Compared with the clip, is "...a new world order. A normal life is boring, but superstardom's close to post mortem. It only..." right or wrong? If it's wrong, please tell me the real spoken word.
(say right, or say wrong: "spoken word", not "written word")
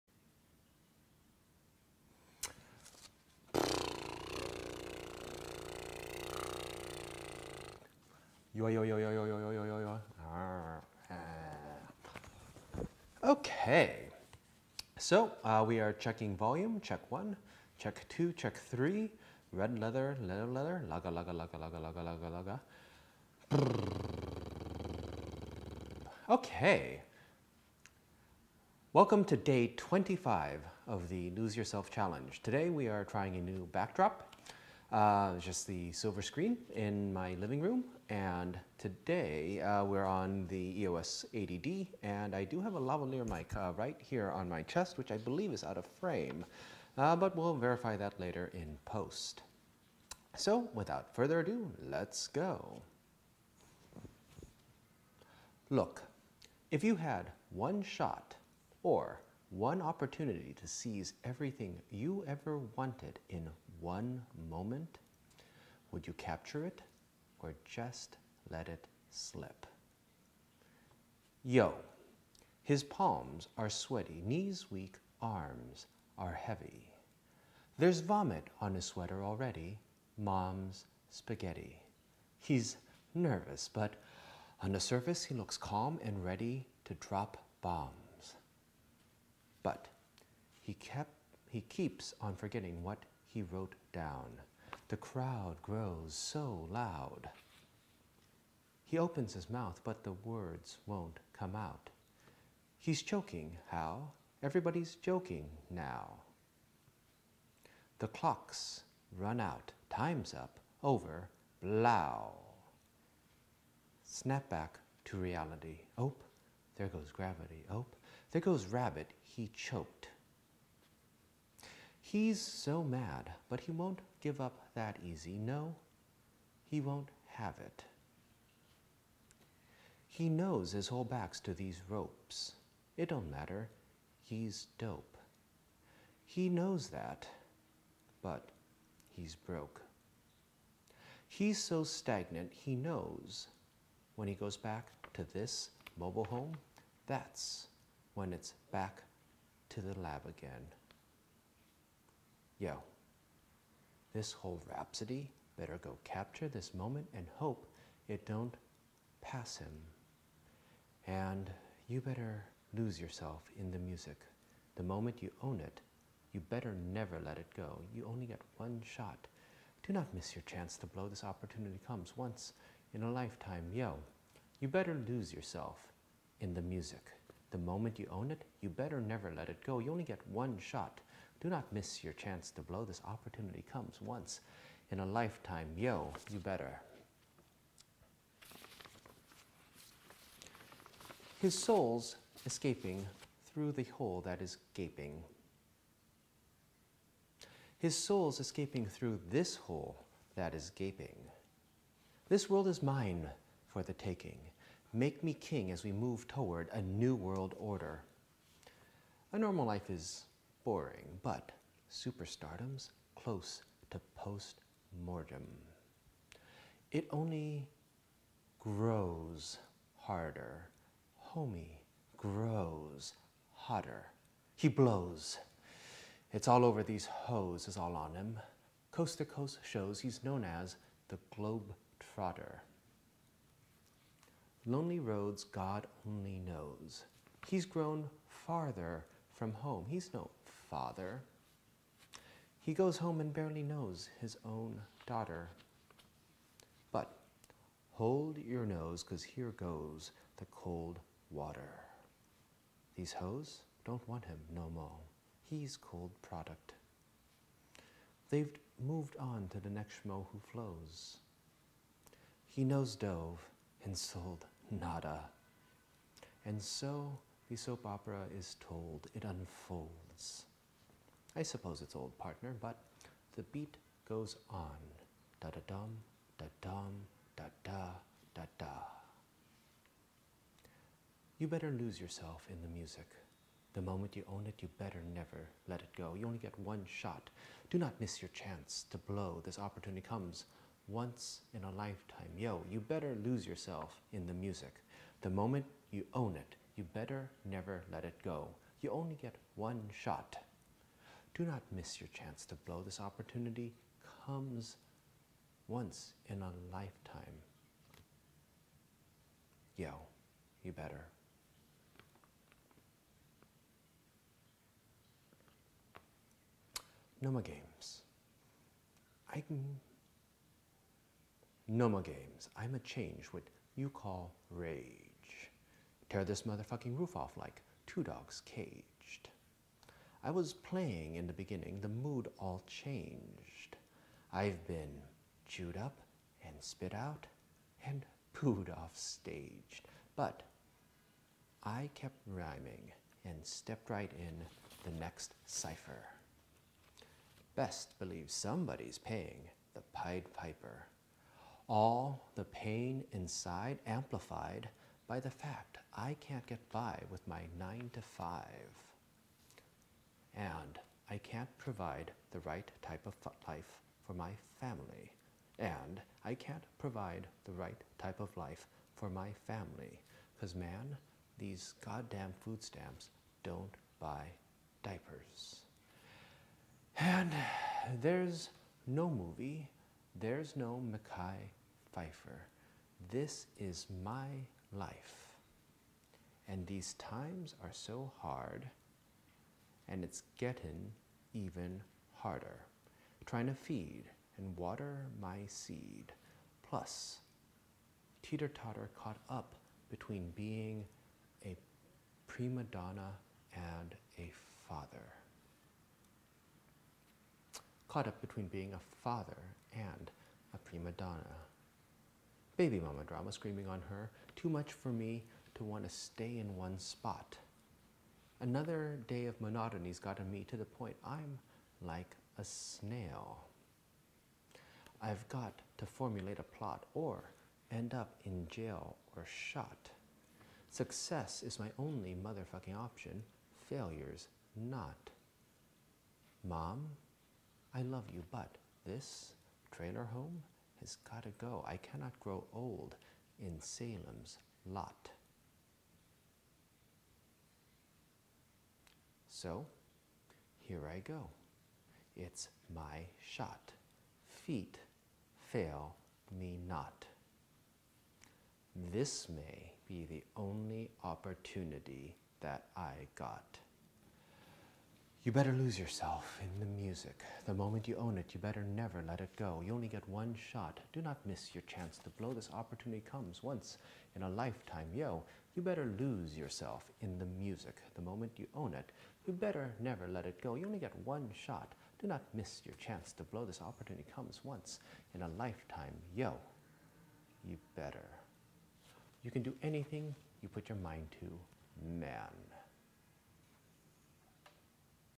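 right.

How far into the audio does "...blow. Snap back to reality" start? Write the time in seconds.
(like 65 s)
111 s.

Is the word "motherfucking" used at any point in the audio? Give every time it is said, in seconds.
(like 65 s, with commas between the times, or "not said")
326 s, 432 s.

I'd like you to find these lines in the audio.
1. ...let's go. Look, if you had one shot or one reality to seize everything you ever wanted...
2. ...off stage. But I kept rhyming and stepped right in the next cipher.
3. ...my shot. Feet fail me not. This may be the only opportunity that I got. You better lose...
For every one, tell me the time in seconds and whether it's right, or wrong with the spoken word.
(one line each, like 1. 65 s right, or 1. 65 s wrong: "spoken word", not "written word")
1. 51 s wrong: "opportunity", not "reality"
2. 338 s right
3. 452 s right.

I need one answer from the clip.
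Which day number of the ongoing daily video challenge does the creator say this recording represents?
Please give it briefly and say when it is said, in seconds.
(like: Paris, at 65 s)
25, at 29 s.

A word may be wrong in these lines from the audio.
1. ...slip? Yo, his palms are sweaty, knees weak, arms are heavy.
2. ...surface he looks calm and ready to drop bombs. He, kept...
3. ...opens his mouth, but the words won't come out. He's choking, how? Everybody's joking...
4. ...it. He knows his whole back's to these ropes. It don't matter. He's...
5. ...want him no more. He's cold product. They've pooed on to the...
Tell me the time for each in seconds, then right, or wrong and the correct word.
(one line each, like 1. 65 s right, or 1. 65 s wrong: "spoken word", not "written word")
1. 69 s right
2. 84 s right
3. 98 s right
4. 127 s right
5. 254 s wrong: "moved", not "pooed".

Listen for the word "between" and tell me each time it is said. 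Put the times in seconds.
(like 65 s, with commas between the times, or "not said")
399 s, 408 s.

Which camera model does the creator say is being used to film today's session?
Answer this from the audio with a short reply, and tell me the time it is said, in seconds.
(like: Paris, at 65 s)
EOS 80D, at 40 s.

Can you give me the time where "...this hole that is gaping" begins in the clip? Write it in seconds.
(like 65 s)
199 s.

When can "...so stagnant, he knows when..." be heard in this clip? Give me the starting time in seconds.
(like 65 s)
141 s.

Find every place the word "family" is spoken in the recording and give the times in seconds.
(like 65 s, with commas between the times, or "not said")
364 s, 369 s.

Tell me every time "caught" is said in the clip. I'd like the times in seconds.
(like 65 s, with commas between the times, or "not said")
399 s, 407 s.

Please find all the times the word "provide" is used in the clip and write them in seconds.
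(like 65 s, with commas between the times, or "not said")
361 s, 366 s.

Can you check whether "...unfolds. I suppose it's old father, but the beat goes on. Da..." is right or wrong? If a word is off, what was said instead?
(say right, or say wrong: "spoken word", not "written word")
wrong: "partner", not "father".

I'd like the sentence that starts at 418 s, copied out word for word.
Another day of monotony's gotten me to the point I'm like a snail.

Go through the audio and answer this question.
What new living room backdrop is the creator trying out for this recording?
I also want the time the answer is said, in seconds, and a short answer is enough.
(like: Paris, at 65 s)
The silver screen, at 35 s.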